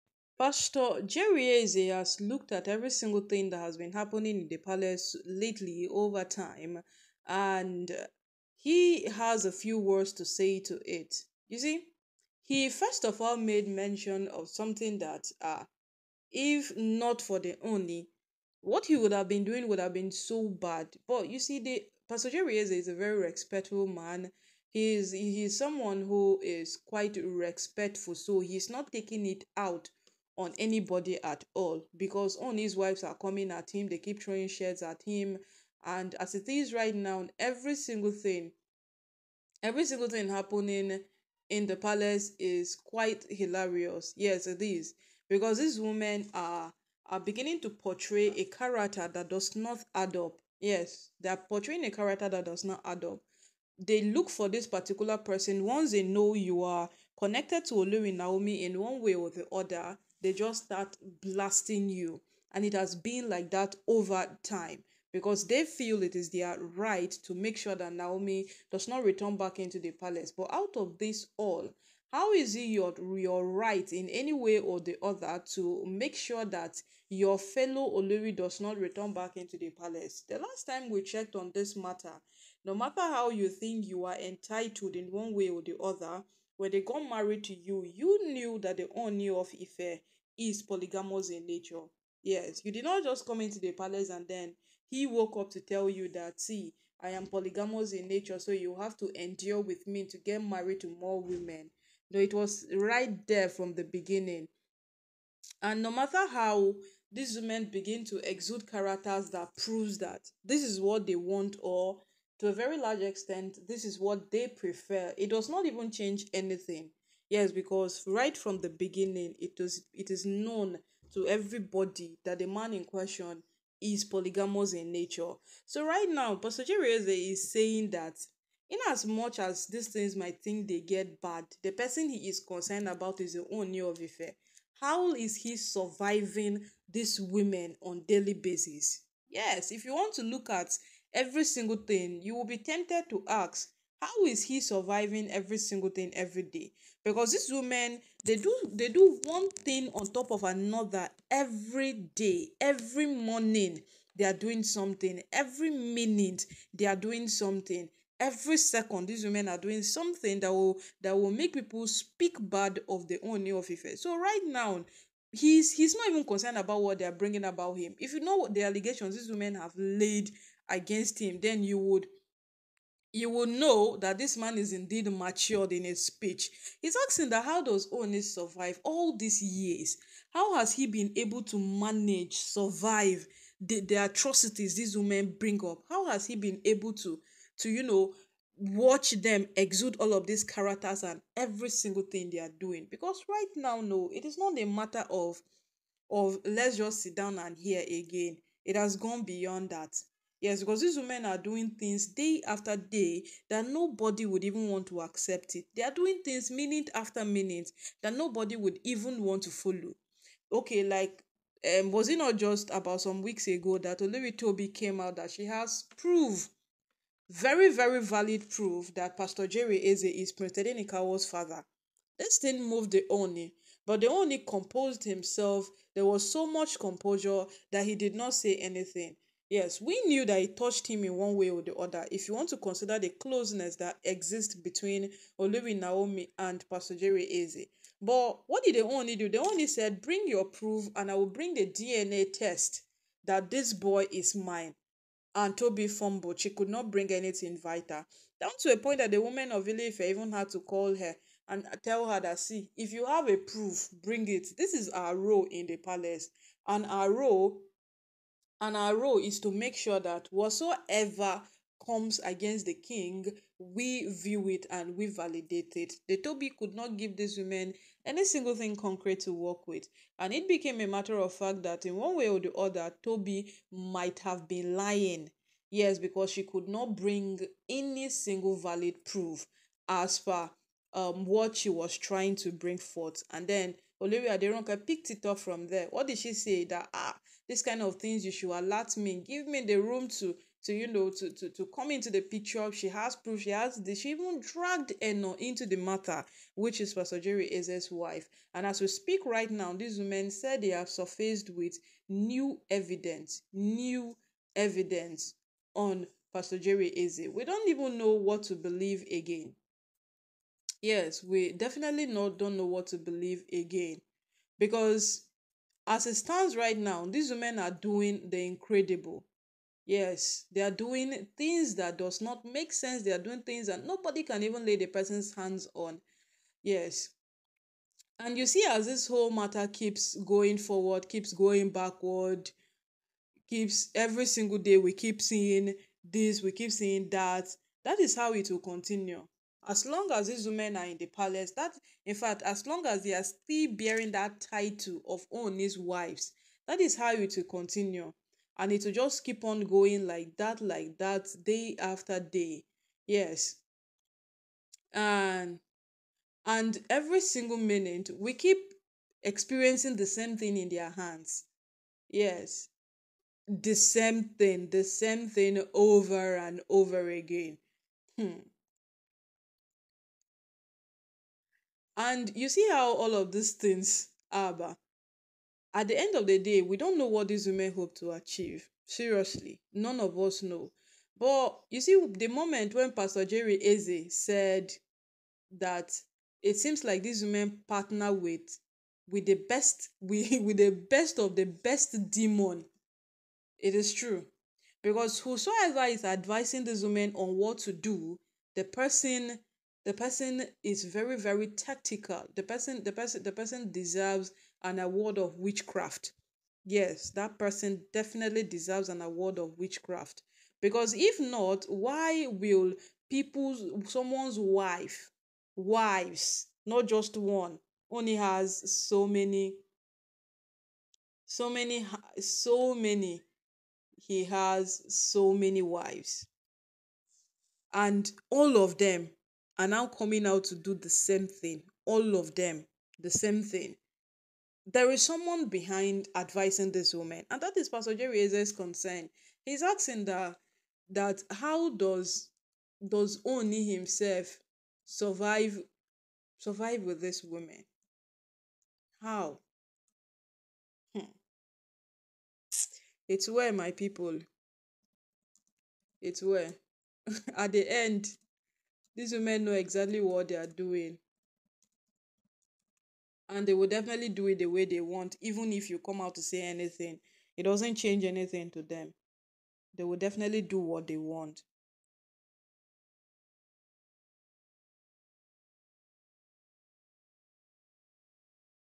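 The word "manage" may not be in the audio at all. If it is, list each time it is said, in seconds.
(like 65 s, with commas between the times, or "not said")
181 s.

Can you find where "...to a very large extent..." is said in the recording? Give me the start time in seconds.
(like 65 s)
112 s.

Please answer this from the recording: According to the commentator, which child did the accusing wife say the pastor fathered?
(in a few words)
Prince Nikawa.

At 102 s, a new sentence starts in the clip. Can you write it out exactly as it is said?
No, it was right there from the beginning.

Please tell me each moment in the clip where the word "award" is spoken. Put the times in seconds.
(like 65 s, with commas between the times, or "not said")
404 s, 409 s.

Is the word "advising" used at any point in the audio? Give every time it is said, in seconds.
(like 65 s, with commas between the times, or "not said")
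396 s, 436 s.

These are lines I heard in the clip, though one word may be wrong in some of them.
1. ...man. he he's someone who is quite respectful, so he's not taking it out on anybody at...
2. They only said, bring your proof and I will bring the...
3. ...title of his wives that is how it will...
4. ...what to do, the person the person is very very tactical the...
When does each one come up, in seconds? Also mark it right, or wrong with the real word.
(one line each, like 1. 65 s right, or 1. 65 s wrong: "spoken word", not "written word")
1. 23 s right
2. 239 s right
3. 344 s right
4. 397 s right.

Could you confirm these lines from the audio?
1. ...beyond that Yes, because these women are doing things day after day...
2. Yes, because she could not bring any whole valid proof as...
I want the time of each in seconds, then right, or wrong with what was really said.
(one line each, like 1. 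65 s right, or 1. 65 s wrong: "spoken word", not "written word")
1. 199 s right
2. 275 s wrong: "single", not "whole".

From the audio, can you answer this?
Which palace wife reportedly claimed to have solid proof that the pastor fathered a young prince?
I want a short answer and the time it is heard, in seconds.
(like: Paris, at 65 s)
Olori Tobi, at 213 s.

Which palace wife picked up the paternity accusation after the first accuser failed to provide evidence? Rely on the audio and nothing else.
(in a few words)
Olivia Deronka.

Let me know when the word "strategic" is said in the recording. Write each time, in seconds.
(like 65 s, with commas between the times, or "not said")
not said.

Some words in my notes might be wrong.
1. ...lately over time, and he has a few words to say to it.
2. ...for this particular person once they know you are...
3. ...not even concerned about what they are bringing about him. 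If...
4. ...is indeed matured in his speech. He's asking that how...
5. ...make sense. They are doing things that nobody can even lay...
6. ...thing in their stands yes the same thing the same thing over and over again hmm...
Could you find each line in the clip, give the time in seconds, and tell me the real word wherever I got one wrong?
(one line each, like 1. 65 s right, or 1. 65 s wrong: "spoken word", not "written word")
1. 5 s right
2. 54 s right
3. 165 s right
4. 174 s right
5. 322 s right
6. 360 s wrong: "hands", not "stands".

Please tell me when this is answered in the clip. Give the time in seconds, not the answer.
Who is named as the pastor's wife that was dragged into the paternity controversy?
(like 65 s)
295 s.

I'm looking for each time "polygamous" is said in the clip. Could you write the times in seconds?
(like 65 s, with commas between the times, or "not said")
90 s, 97 s, 124 s.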